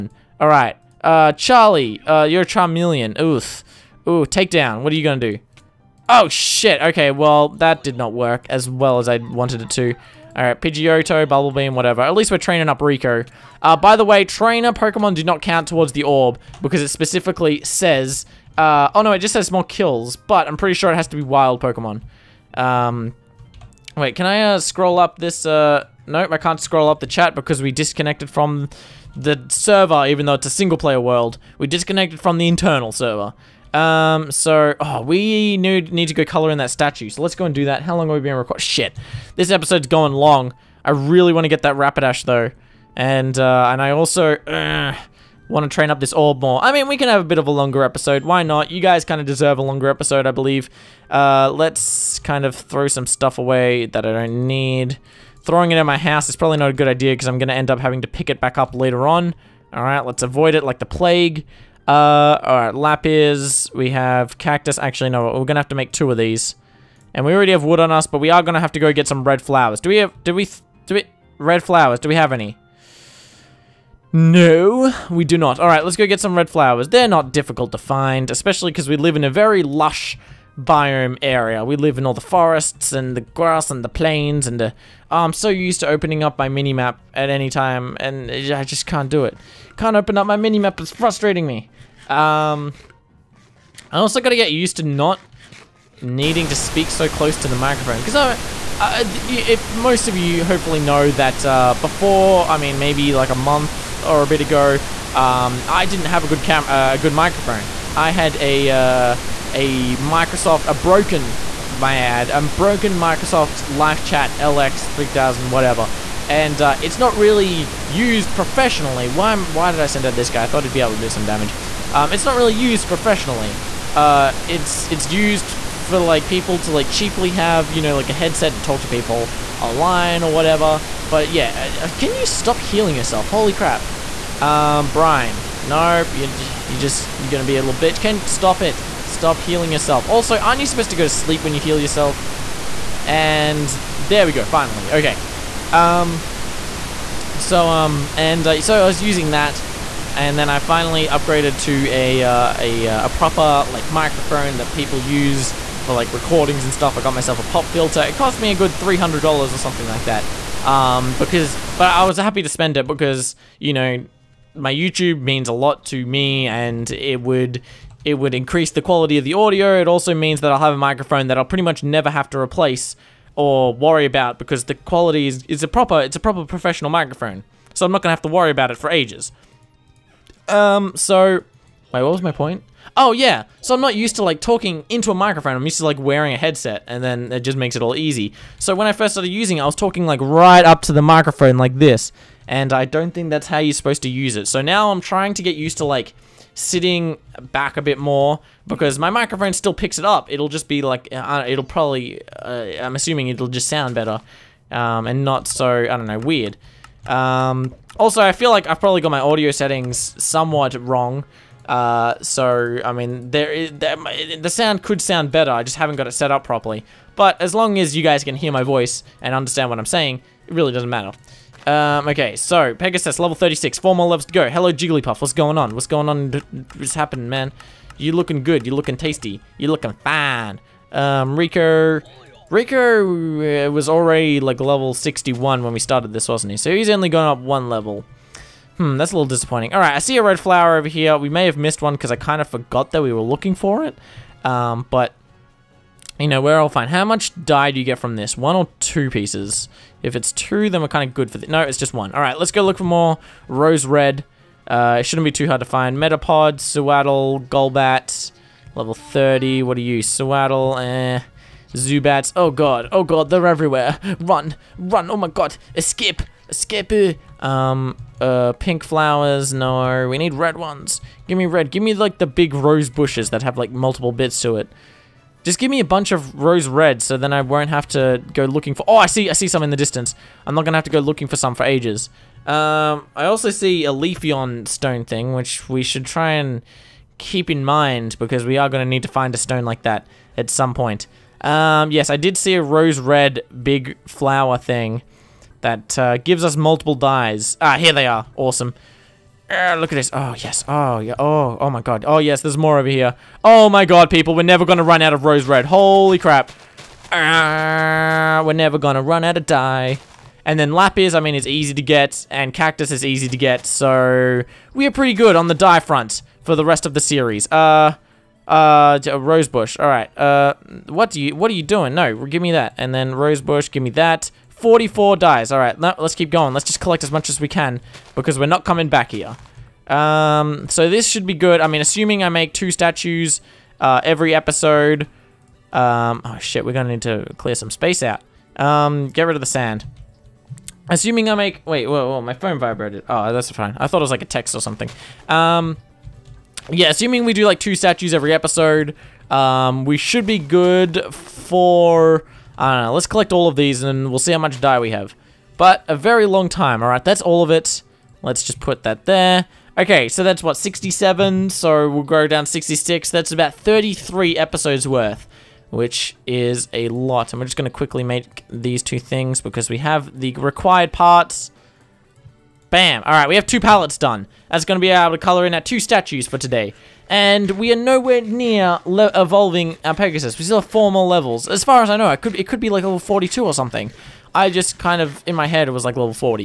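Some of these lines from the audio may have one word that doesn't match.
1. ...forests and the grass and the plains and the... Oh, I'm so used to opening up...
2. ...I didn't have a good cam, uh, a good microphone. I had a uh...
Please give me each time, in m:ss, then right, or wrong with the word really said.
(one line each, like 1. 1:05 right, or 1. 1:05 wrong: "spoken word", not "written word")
1. 1:22 right
2. 1:45 right.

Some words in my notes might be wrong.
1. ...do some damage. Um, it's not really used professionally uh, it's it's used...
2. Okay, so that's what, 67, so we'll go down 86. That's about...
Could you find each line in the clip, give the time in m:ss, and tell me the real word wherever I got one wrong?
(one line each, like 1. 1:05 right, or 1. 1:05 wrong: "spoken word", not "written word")
1. 2:01 right
2. 5:59 wrong: "66", not "86".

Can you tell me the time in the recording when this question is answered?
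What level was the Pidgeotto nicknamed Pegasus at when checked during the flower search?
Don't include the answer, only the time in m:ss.
3:43.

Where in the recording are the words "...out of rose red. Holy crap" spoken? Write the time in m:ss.
5:05.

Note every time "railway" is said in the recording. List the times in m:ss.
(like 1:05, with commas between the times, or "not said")
not said.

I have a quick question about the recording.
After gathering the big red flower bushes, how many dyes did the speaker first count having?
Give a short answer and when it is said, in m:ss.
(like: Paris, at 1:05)
44, at 5:24.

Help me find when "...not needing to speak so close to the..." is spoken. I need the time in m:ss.
1:34.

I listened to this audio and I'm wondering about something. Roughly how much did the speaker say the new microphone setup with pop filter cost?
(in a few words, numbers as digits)
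300 dollars.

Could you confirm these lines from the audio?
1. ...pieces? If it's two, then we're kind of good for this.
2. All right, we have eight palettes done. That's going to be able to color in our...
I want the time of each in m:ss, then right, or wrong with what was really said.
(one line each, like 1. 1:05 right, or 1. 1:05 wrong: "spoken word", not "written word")
1. 4:09 right
2. 6:13 wrong: "two", not "eight".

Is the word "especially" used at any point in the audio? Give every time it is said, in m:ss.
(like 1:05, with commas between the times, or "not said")
1:18.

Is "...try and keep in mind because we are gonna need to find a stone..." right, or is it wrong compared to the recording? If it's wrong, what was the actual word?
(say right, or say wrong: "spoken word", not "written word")
right.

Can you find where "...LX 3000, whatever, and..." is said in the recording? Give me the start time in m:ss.
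1:54.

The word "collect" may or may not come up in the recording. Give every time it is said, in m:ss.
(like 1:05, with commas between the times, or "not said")
5:26, 5:53.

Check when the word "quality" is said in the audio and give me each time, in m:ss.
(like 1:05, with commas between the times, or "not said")
2:48, 2:54.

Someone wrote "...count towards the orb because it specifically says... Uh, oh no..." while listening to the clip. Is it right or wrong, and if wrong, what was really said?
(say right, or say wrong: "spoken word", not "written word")
right.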